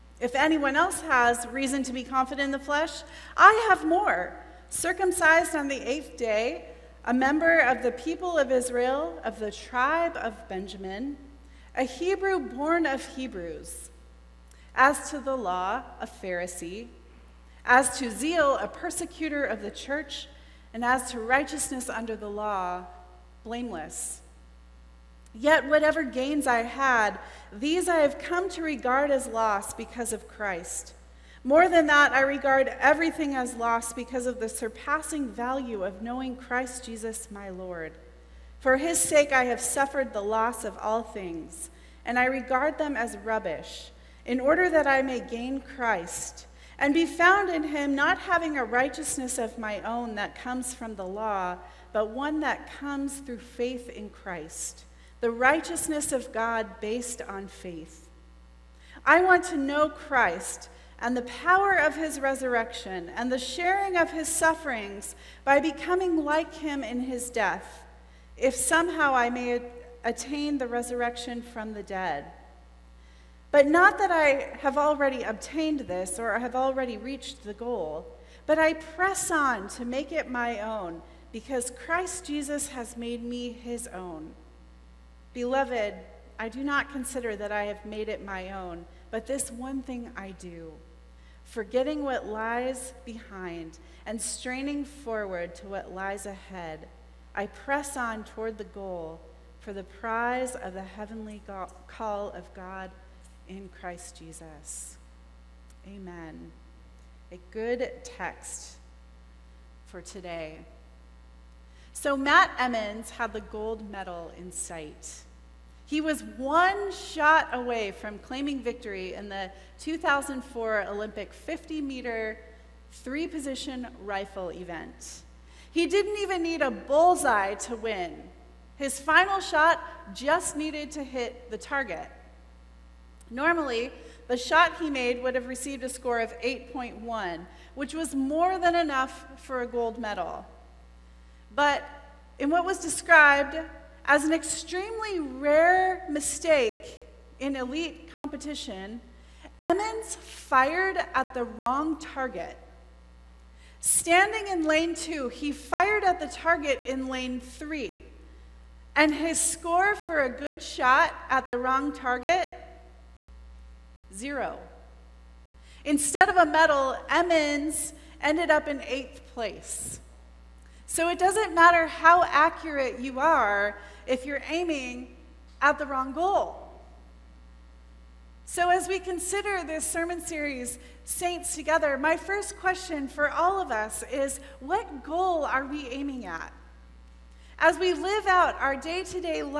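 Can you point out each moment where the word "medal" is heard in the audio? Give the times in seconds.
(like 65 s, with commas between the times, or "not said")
113 s, 139 s, 166 s.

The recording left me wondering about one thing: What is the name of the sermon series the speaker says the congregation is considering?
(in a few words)
Saints Together.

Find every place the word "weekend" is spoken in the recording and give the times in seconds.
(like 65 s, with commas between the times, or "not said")
not said.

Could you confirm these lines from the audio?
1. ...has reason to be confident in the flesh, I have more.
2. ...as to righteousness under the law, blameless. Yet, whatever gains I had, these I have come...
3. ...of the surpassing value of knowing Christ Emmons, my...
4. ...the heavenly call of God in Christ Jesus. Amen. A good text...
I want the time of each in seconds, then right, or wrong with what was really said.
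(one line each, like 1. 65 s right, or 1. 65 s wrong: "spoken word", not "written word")
1. 1 s right
2. 20 s right
3. 34 s wrong: "Jesus", not "Emmons"
4. 100 s right.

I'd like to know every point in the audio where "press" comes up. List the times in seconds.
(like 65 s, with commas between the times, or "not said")
78 s, 97 s.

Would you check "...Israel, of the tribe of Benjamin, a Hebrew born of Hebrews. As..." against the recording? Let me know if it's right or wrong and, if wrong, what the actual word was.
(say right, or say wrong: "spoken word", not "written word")
right.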